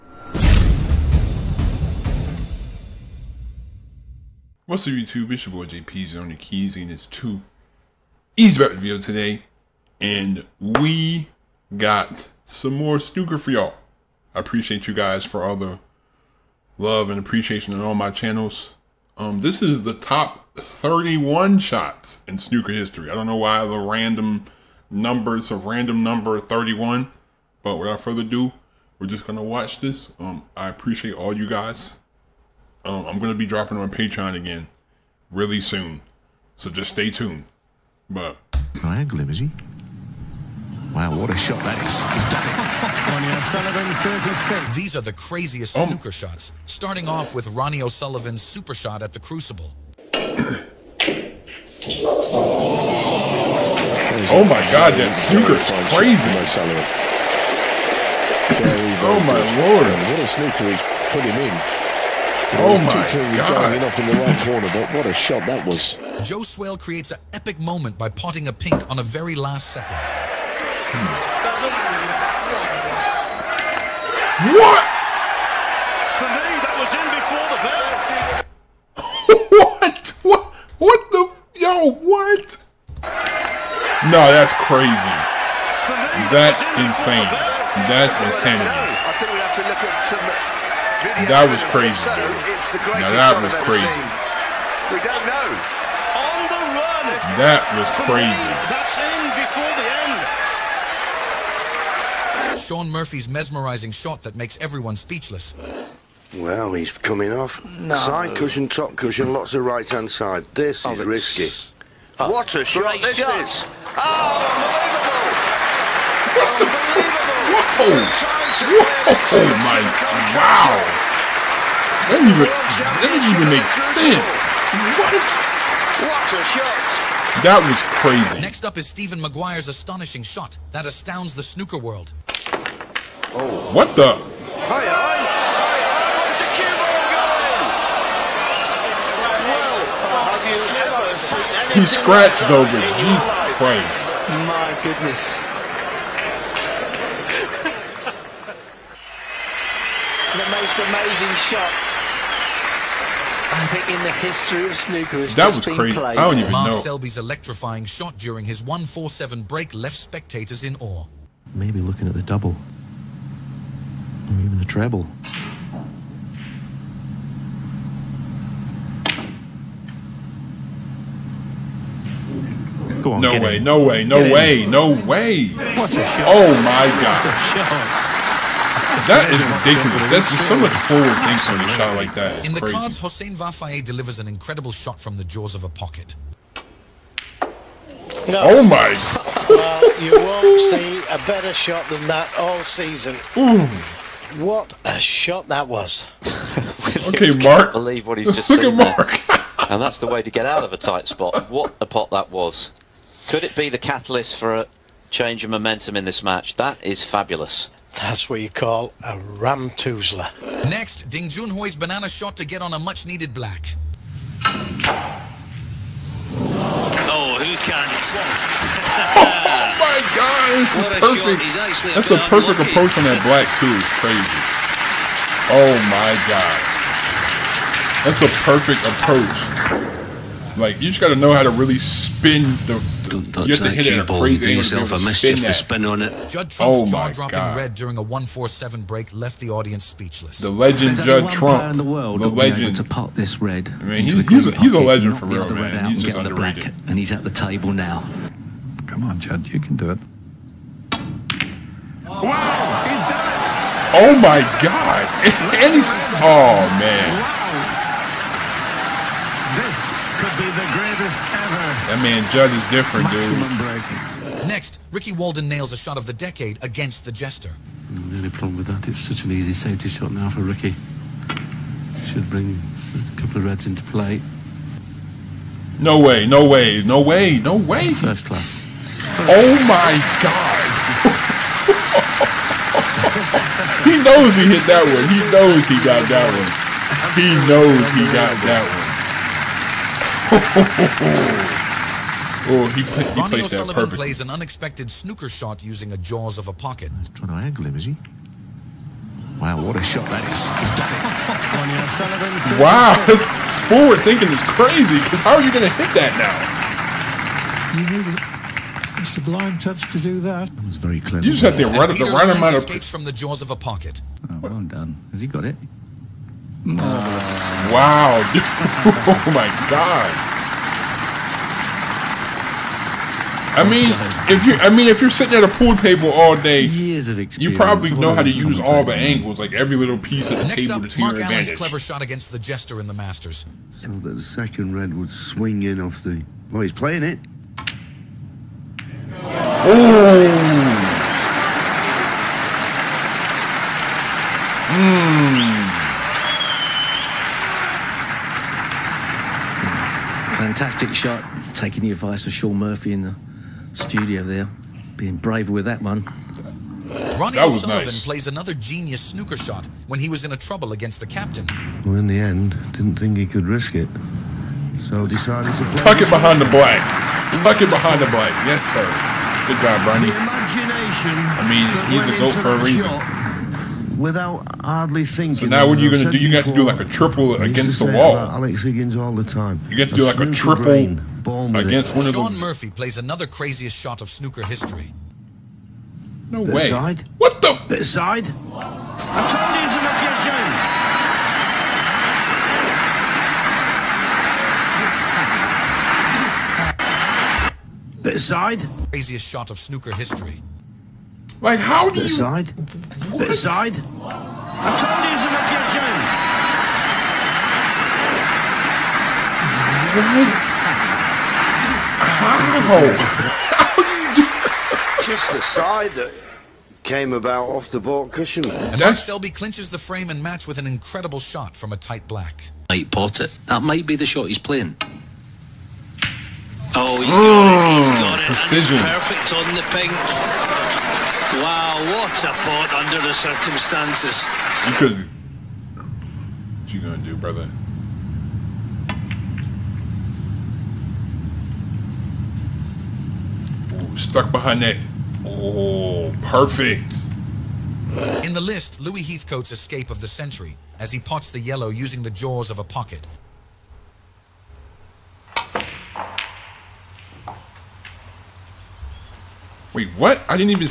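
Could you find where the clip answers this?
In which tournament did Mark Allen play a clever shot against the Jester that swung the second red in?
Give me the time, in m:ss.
5:32.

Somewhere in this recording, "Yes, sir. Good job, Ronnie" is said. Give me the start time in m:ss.
6:08.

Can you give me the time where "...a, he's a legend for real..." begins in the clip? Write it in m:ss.
4:04.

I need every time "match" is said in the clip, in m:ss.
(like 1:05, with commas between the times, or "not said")
3:26, 7:00.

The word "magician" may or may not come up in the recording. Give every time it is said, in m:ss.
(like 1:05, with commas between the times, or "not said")
6:28, 6:45.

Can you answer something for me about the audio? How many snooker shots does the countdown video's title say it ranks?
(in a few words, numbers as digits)
31.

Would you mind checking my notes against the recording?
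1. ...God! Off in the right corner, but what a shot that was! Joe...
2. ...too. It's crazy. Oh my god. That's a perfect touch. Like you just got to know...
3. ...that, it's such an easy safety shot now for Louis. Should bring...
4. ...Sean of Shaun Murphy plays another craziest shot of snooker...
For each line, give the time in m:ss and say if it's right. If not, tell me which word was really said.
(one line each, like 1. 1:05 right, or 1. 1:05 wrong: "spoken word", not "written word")
1. 1:03 right
2. 3:43 wrong: "approach", not "touch"
3. 4:28 wrong: "Ricky", not "Louis"
4. 6:22 right.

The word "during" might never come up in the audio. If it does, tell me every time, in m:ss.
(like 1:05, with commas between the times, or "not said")
2:38, 3:57.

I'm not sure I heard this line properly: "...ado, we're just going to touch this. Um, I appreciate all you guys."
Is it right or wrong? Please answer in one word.
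wrong.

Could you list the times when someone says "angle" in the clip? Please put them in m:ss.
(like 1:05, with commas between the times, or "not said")
0:38, 4:57, 5:28.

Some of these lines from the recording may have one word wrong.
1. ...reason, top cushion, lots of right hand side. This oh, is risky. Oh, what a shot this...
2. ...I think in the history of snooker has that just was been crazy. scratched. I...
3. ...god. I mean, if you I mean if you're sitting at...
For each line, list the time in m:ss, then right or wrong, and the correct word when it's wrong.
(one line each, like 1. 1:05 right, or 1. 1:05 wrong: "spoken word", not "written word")
1. 1:48 wrong: "cushion", not "reason"
2. 2:33 wrong: "played", not "scratched"
3. 5:19 right.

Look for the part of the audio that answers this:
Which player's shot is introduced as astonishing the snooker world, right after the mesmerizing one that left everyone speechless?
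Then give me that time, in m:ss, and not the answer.
2:08.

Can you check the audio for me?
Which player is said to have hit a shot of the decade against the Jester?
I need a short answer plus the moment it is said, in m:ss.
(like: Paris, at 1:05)
Ricky Walden, at 4:24.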